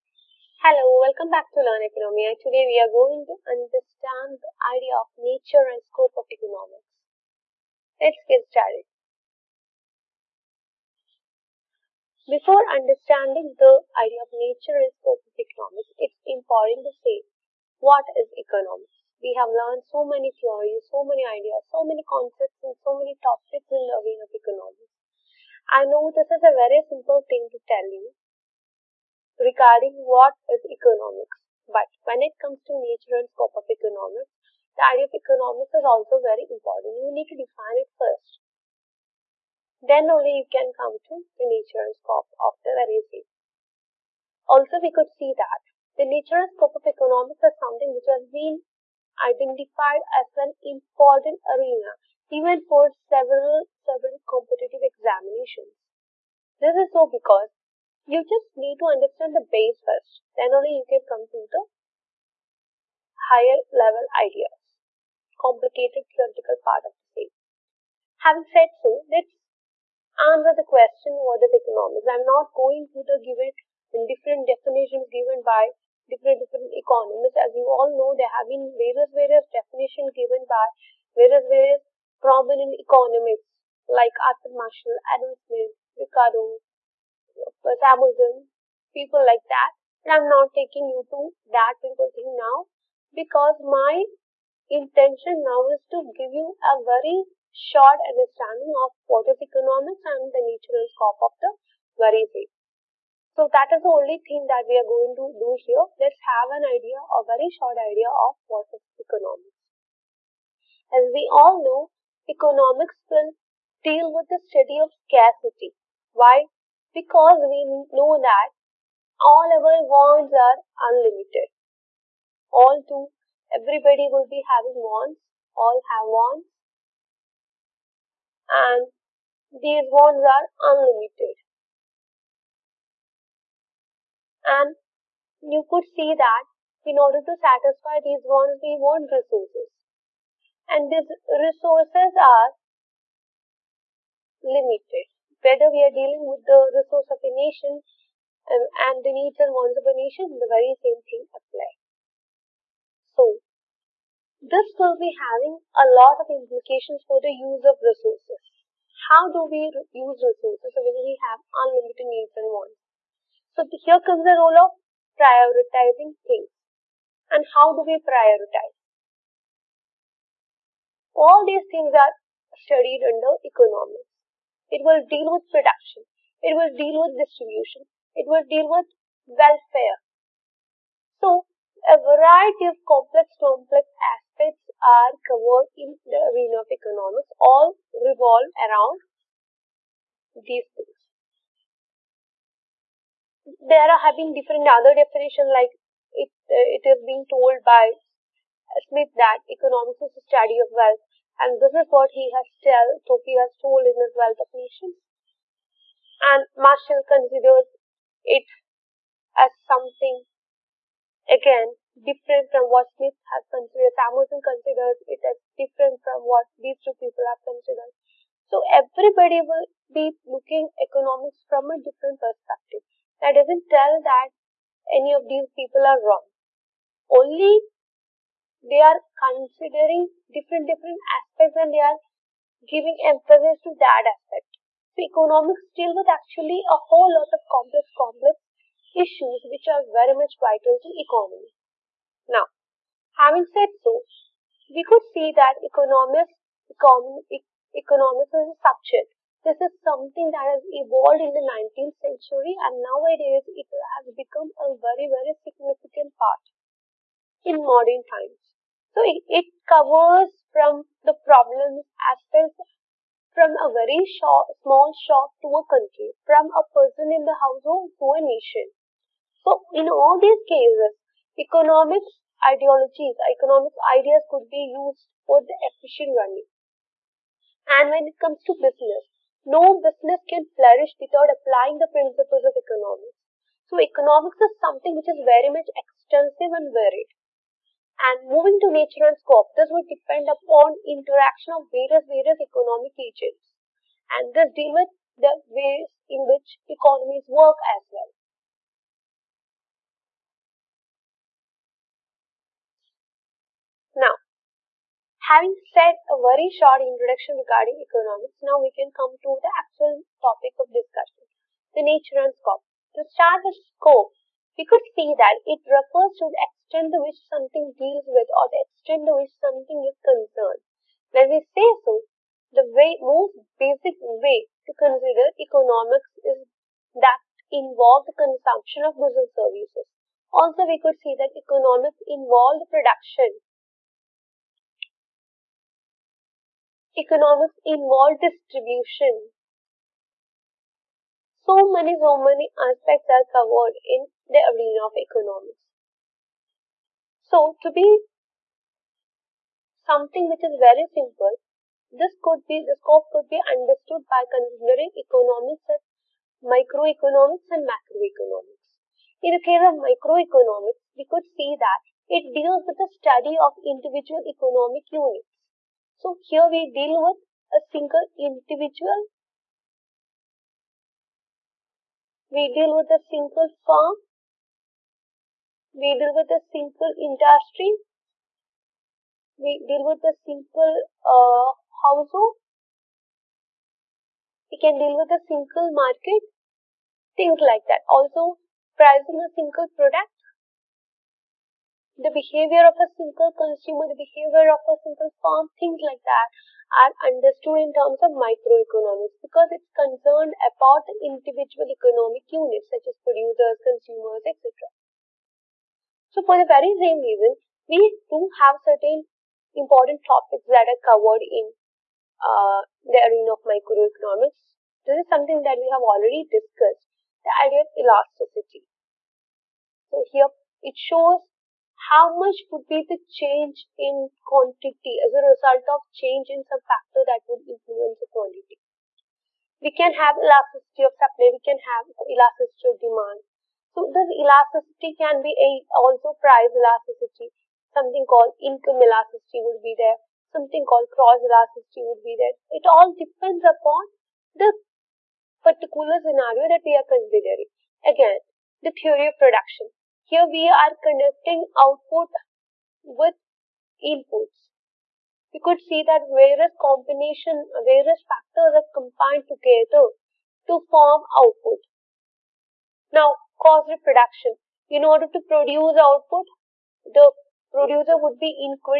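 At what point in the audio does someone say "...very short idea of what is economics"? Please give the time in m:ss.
1:47.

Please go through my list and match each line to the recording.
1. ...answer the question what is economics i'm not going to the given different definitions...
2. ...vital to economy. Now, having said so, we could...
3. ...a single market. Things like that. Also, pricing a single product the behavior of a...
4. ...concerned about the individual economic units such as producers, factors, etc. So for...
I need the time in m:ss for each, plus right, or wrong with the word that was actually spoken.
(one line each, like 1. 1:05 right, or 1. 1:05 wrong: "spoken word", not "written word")
1. 1:10 right
2. 4:00 right
3. 6:25 right
4. 6:39 wrong: "consumers", not "factors".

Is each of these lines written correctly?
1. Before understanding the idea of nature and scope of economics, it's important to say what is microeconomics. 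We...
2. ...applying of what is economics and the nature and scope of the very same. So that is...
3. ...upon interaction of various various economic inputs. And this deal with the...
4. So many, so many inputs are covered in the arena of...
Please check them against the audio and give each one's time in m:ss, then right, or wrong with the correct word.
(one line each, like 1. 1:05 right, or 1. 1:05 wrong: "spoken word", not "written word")
1. 0:12 wrong: "economics", not "microeconomics"
2. 1:38 wrong: "understanding", not "applying"
3. 4:50 wrong: "agents", not "inputs"
4. 5:41 wrong: "aspects", not "inputs".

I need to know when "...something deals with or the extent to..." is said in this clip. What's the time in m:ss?
5:17.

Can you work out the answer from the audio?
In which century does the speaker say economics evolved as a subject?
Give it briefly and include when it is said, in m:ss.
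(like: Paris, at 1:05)
19th century, at 4:11.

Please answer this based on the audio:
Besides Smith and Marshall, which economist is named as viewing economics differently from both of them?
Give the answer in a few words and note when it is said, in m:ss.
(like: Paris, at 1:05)
Samuelson, at 3:33.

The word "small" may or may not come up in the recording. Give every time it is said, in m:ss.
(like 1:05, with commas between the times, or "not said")
4:24.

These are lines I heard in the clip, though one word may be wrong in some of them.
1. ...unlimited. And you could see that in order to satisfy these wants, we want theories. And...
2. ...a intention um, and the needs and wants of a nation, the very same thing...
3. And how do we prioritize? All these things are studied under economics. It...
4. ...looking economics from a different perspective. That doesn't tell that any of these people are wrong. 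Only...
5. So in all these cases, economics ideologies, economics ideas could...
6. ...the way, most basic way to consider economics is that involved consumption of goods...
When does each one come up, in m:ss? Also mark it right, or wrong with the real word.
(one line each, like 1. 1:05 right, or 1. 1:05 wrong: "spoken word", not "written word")
1. 2:10 wrong: "resources", not "theories"
2. 2:27 wrong: "nation", not "intention"
3. 2:47 right
4. 3:40 right
5. 4:29 right
6. 5:22 right.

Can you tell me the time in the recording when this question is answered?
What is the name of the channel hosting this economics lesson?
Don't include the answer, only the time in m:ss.
0:01.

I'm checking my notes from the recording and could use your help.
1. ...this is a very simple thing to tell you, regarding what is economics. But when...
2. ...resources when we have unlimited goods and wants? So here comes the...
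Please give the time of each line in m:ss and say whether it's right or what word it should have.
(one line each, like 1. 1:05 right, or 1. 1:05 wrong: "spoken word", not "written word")
1. 0:26 right
2. 2:40 wrong: "needs", not "goods".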